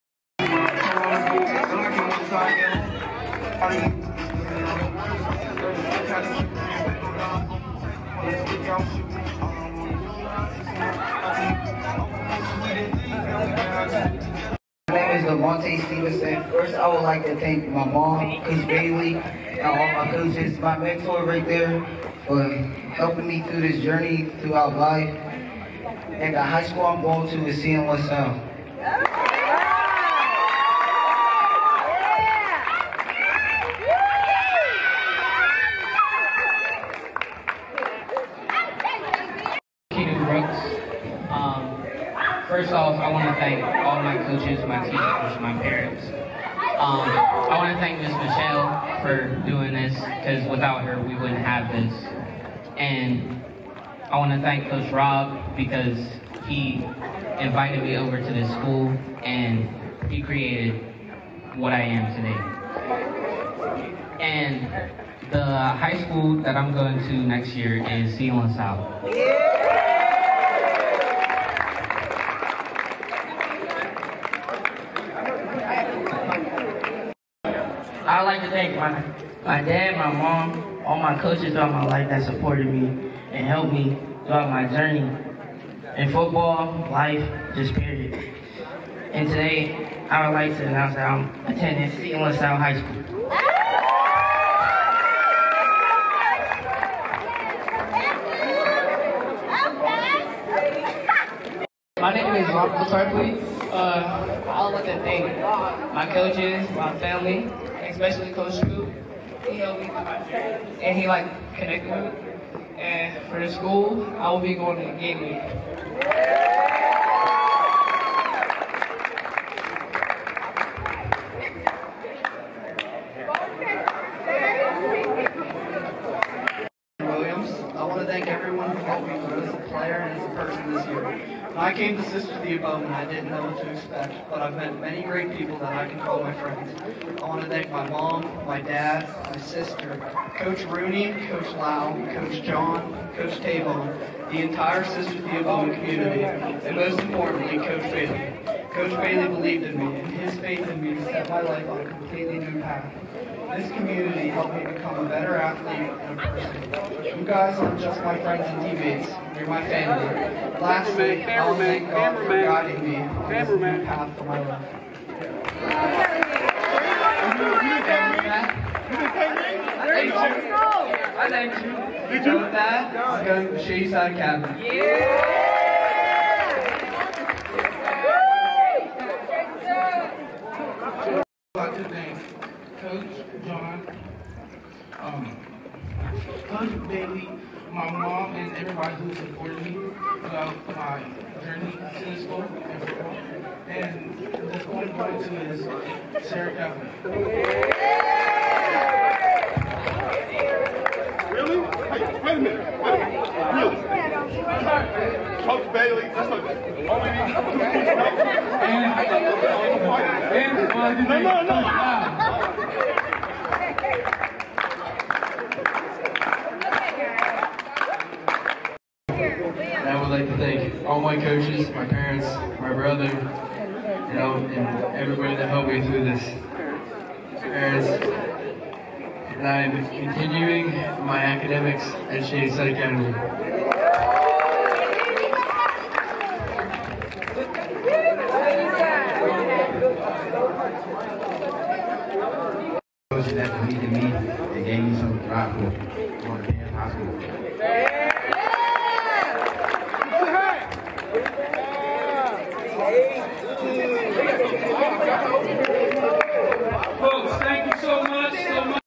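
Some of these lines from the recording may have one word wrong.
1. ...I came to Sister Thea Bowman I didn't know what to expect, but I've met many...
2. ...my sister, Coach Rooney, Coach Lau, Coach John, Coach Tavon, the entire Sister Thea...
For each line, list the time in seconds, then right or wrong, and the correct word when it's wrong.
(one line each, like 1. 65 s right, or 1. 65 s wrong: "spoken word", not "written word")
1. 131 s right
2. 139 s right.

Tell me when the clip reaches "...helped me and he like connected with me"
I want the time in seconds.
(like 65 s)
109 s.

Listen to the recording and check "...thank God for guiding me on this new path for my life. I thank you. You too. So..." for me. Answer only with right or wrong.
right.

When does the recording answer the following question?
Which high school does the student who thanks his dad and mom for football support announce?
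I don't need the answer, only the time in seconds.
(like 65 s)
91 s.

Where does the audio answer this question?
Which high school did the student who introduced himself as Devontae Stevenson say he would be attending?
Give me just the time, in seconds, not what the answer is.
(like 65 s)
27 s.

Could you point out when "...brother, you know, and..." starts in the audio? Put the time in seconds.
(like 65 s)
222 s.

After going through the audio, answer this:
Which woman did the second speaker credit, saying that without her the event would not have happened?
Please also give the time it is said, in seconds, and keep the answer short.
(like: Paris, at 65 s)
Miss Michelle, at 48 s.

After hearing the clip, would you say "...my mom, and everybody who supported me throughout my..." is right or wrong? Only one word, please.
right.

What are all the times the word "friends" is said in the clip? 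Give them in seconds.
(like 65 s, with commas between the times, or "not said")
136 s, 158 s.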